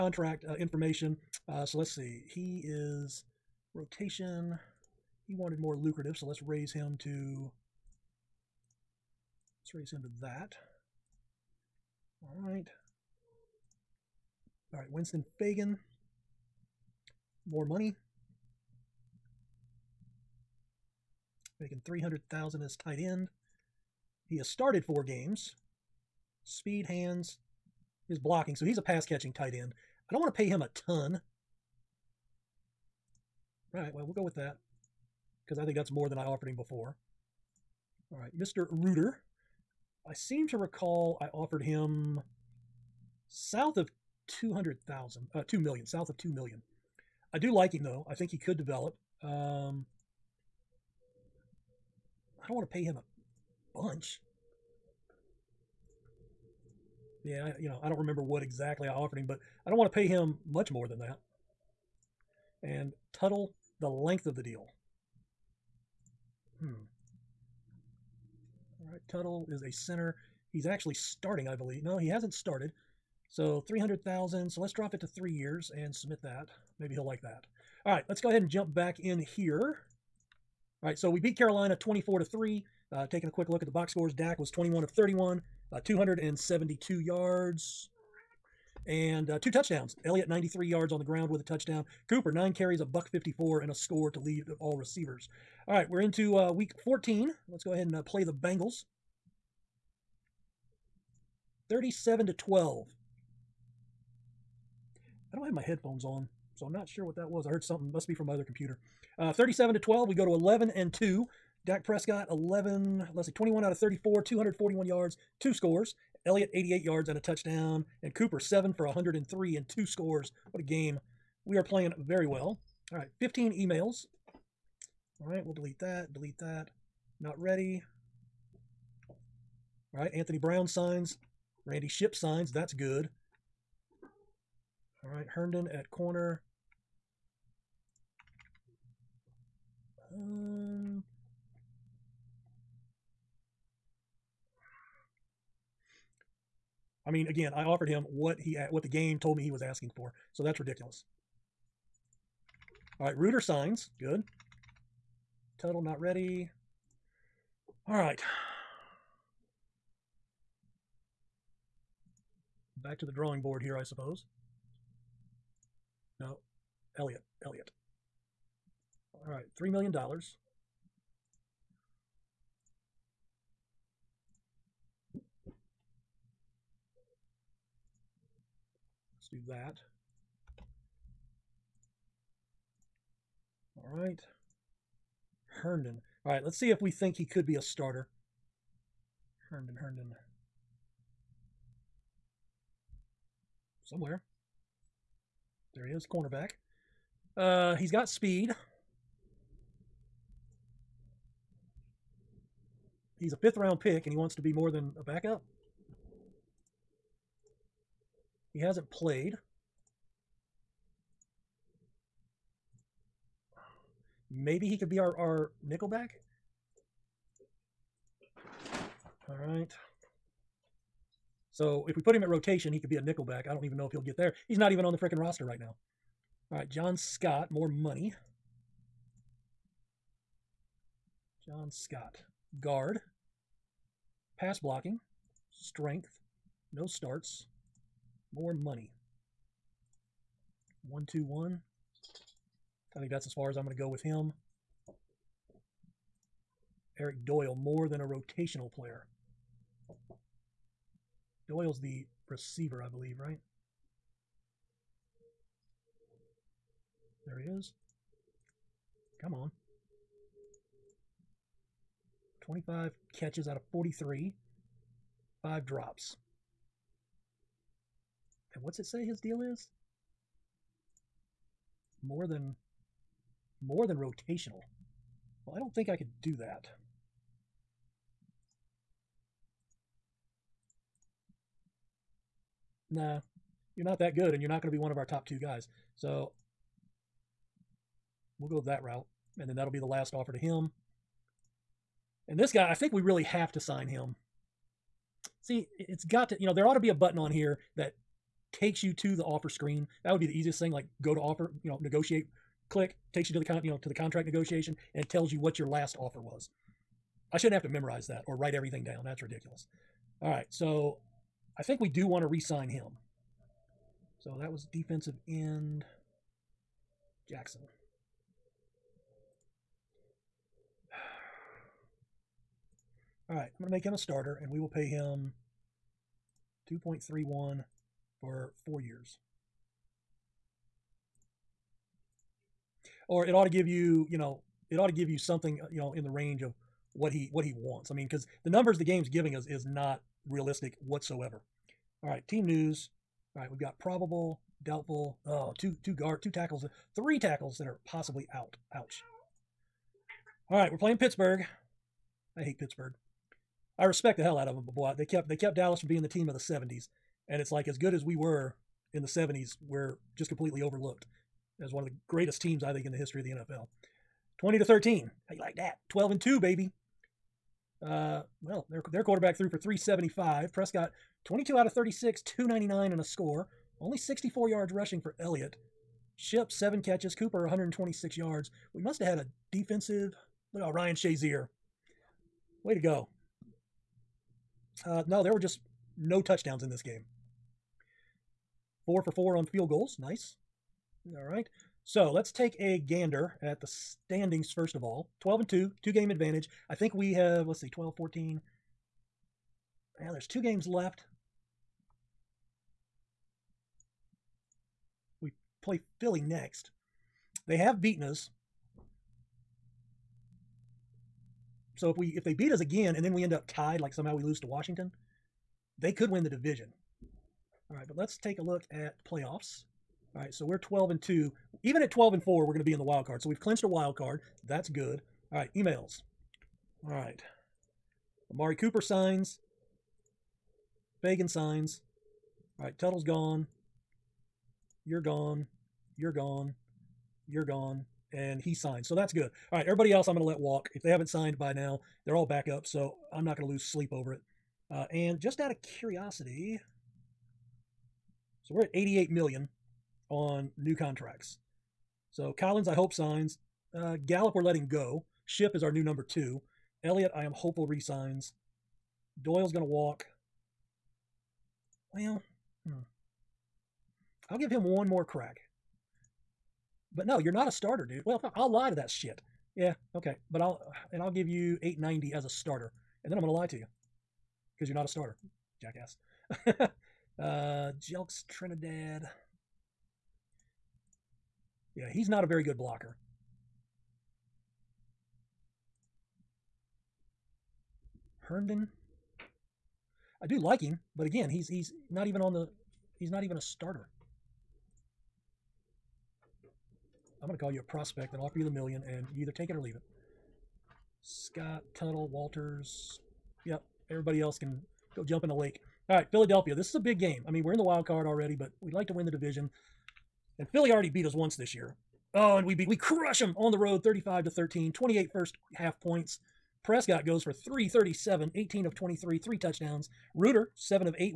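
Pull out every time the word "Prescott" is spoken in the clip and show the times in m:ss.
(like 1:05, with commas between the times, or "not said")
1:51, 6:10, 8:36.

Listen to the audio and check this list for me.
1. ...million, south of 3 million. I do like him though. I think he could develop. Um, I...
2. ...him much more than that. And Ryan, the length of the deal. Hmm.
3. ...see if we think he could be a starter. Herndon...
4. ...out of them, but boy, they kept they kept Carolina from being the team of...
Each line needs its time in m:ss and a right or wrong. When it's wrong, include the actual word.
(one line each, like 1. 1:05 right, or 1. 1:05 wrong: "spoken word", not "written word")
1. 0:45 wrong: "2", not "3"
2. 1:00 wrong: "Tuttle", not "Ryan"
3. 3:06 right
4. 5:54 wrong: "Dallas", not "Carolina".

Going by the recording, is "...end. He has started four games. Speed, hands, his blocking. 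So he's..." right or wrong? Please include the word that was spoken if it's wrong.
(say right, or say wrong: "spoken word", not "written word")
right.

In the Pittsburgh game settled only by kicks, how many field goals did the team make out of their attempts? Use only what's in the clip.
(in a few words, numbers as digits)
4 for 4.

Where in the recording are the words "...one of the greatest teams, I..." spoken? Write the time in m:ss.
6:01.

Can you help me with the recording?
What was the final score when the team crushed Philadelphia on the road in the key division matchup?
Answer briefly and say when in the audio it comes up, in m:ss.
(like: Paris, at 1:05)
35 to 13, at 8:33.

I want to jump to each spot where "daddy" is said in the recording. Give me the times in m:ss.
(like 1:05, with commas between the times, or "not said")
not said.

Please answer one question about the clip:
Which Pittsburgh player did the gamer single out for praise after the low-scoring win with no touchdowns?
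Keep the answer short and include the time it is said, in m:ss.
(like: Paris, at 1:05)
Ryan Shazier, at 6:20.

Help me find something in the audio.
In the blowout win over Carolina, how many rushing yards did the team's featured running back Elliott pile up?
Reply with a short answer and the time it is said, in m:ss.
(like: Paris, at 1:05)
93, at 1:30.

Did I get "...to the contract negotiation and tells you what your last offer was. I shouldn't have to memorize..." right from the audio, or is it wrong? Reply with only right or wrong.
right.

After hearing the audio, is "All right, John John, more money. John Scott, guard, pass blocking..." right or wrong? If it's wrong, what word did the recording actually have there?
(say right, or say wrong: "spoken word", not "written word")
wrong: "Scott", not "John".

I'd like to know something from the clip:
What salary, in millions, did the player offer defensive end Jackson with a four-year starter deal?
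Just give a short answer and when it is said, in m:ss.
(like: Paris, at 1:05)
2.31, at 5:26.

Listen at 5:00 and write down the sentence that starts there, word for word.
That would be the easiest thing.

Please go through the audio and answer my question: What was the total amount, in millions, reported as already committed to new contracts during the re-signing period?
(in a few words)
88 million.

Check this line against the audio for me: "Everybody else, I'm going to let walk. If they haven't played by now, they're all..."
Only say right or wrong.
wrong.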